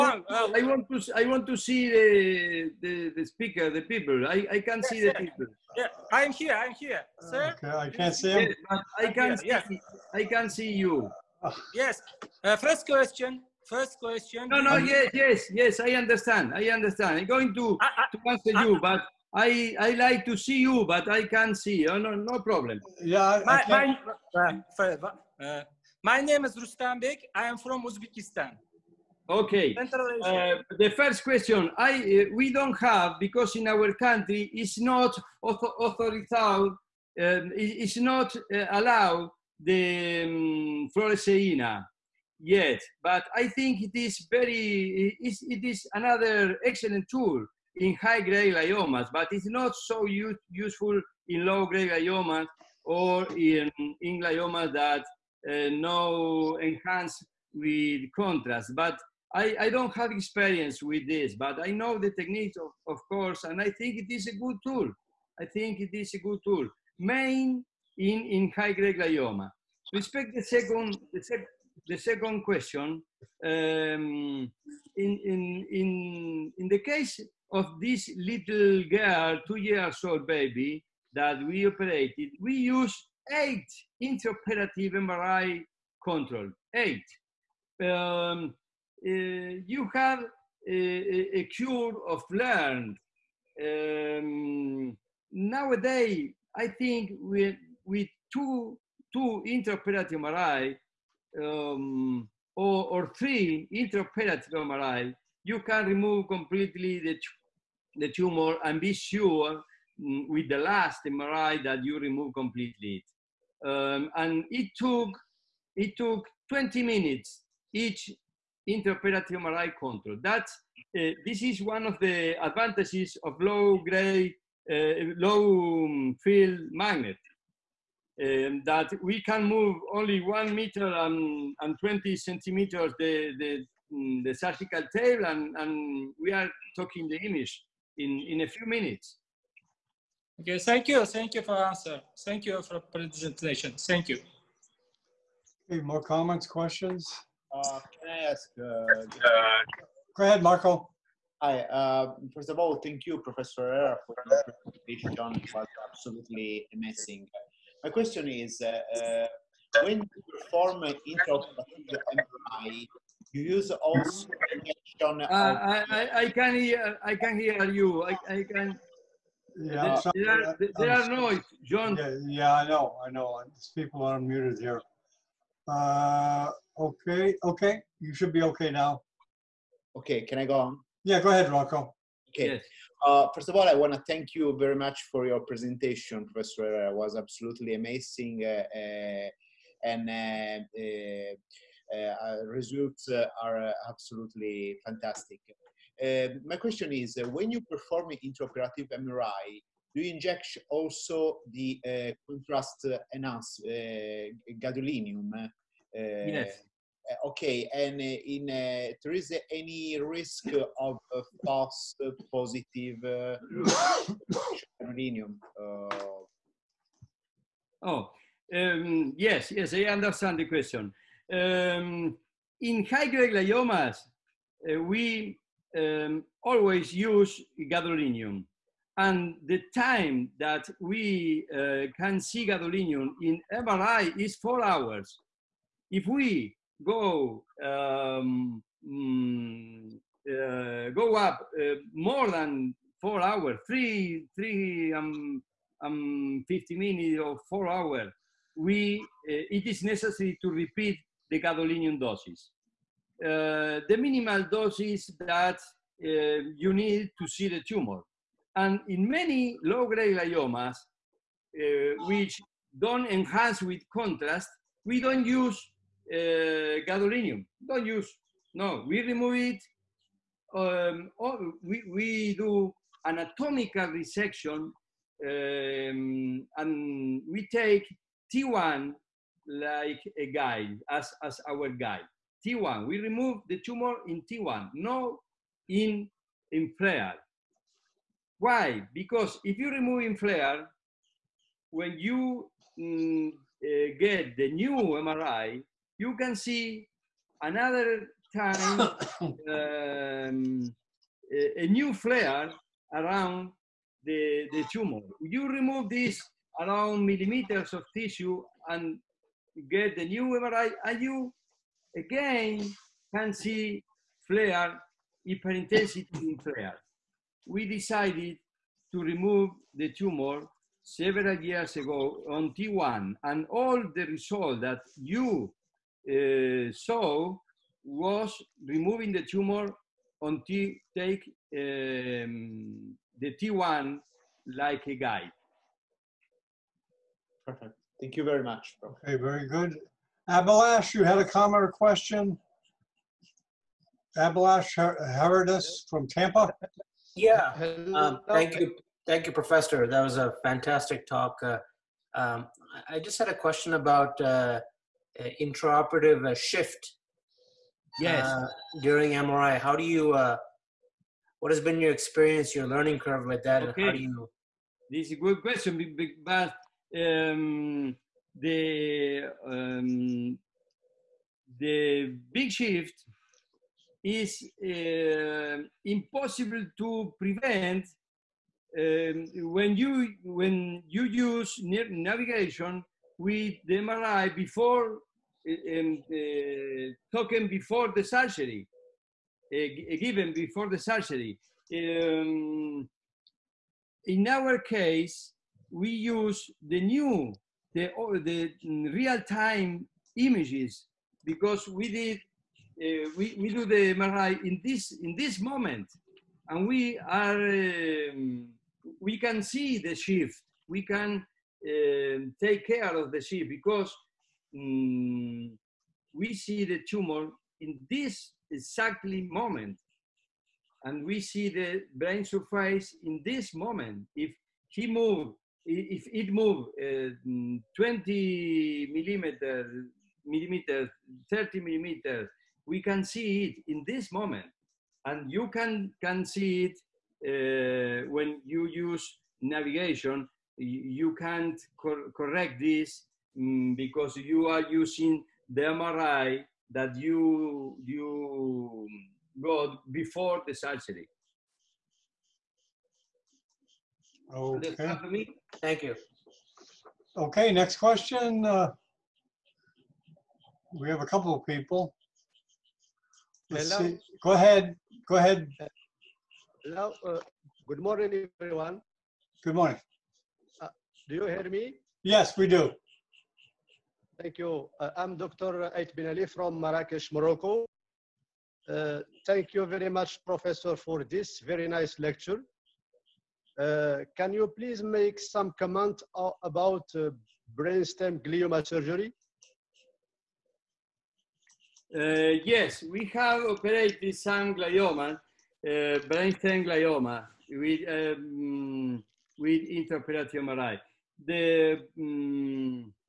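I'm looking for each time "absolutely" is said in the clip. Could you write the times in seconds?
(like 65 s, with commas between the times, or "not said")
155 s, 187 s, 193 s.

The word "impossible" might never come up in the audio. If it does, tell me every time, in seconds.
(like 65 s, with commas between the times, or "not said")
375 s.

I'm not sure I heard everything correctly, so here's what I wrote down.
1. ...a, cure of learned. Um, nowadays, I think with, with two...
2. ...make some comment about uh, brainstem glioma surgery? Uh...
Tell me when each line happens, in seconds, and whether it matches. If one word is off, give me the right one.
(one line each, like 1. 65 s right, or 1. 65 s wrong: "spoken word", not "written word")
1. 91 s right
2. 484 s right.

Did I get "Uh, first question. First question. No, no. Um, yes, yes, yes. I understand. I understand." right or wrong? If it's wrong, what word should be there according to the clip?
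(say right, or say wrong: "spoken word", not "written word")
right.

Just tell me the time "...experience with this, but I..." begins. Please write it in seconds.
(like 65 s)
60 s.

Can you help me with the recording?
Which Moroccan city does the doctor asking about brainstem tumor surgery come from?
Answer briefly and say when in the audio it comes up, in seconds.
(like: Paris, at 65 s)
Marrakesh, at 476 s.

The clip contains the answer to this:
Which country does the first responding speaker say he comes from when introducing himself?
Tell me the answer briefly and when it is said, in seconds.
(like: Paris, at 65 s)
Uzbekistan, at 27 s.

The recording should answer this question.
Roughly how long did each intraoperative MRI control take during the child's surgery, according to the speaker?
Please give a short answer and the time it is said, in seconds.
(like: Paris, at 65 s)
20 minutes, at 116 s.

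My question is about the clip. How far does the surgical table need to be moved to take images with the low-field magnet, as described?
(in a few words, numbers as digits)
1 meter 20 centimeters.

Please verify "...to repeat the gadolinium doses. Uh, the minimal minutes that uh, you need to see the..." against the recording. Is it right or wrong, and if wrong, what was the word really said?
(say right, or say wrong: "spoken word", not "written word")
wrong: "doses", not "minutes".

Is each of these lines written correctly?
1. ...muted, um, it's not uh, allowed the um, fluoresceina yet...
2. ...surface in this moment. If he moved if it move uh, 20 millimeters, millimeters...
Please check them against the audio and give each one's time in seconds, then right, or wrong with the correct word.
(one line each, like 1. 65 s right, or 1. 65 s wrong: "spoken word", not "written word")
1. 35 s wrong: "authorized", not "muted"
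2. 422 s right.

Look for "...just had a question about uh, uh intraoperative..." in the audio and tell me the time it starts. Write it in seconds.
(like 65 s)
352 s.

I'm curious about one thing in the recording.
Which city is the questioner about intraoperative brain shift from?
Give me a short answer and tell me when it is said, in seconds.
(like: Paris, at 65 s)
Tampa, at 346 s.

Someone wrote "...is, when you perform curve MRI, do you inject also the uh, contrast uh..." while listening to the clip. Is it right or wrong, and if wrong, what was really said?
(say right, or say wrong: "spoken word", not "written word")
wrong: "intraoperative", not "curve".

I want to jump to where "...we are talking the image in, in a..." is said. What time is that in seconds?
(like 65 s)
136 s.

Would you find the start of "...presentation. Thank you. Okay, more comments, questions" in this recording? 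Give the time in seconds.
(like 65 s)
142 s.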